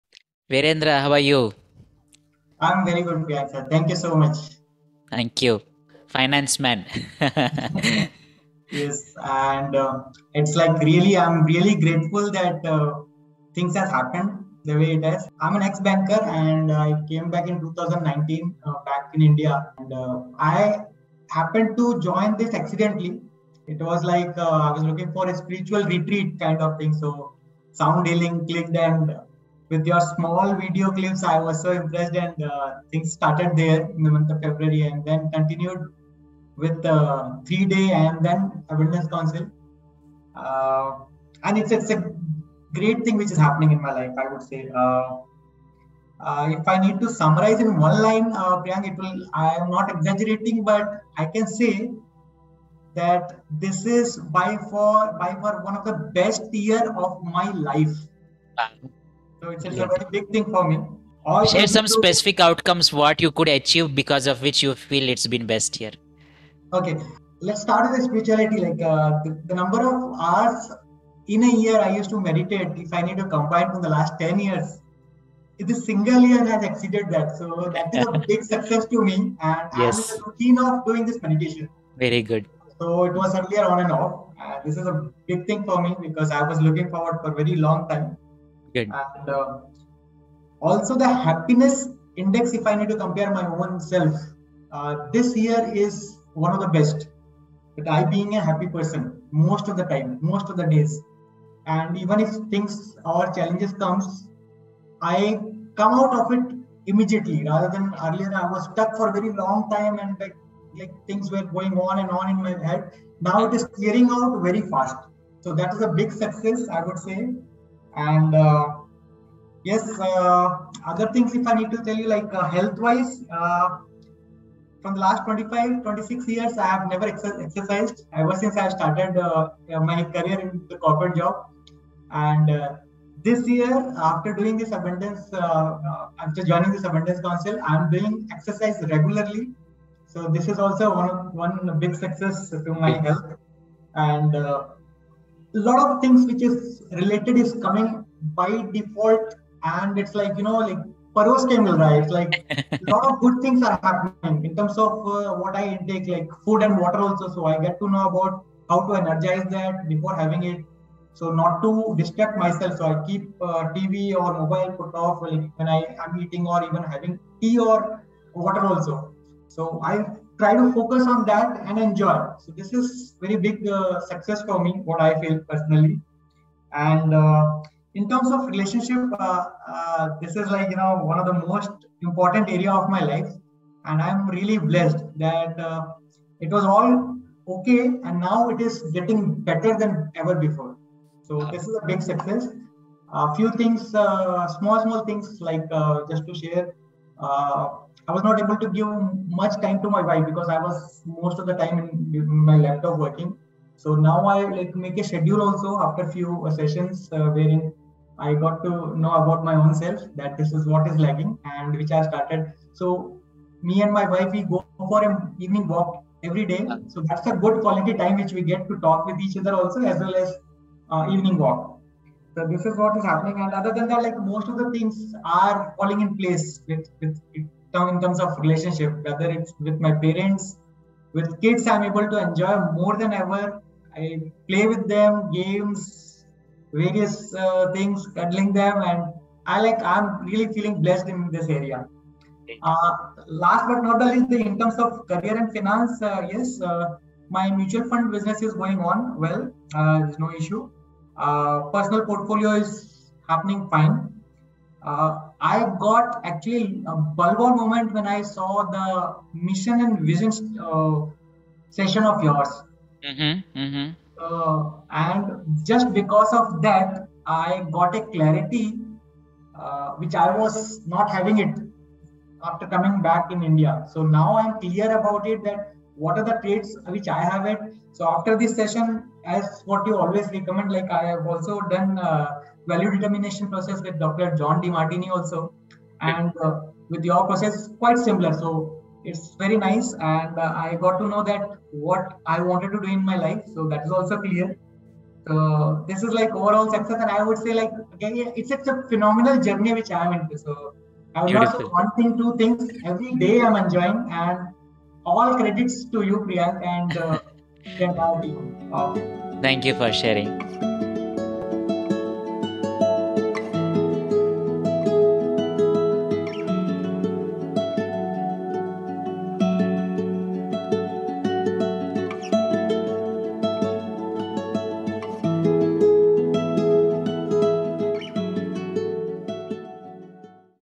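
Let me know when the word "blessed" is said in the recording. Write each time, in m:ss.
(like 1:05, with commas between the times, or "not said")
3:04, 4:00.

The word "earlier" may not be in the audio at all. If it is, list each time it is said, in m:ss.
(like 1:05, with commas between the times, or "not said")
1:23, 1:48.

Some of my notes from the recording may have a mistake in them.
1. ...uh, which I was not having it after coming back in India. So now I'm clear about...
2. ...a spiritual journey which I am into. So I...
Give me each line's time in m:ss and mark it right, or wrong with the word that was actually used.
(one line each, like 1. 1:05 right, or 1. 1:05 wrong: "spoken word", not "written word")
1. 4:29 right
2. 4:58 wrong: "phenomenal", not "spiritual".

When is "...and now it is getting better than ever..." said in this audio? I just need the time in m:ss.
3:08.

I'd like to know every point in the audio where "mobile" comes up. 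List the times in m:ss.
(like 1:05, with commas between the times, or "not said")
2:44.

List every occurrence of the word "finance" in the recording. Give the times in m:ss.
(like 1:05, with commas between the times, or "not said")
0:06, 4:05.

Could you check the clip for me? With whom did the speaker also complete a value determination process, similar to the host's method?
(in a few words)
Dr. John Demartini.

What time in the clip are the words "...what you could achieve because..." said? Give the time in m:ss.
1:02.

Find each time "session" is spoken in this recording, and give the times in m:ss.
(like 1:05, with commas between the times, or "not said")
3:26, 4:21, 4:38.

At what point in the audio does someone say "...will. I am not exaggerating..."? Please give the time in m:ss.
0:48.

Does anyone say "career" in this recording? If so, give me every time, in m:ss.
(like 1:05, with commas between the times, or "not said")
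2:10, 4:05.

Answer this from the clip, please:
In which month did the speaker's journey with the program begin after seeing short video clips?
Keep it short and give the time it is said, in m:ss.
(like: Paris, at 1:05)
February, at 0:34.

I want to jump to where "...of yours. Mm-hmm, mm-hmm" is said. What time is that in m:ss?
4:22.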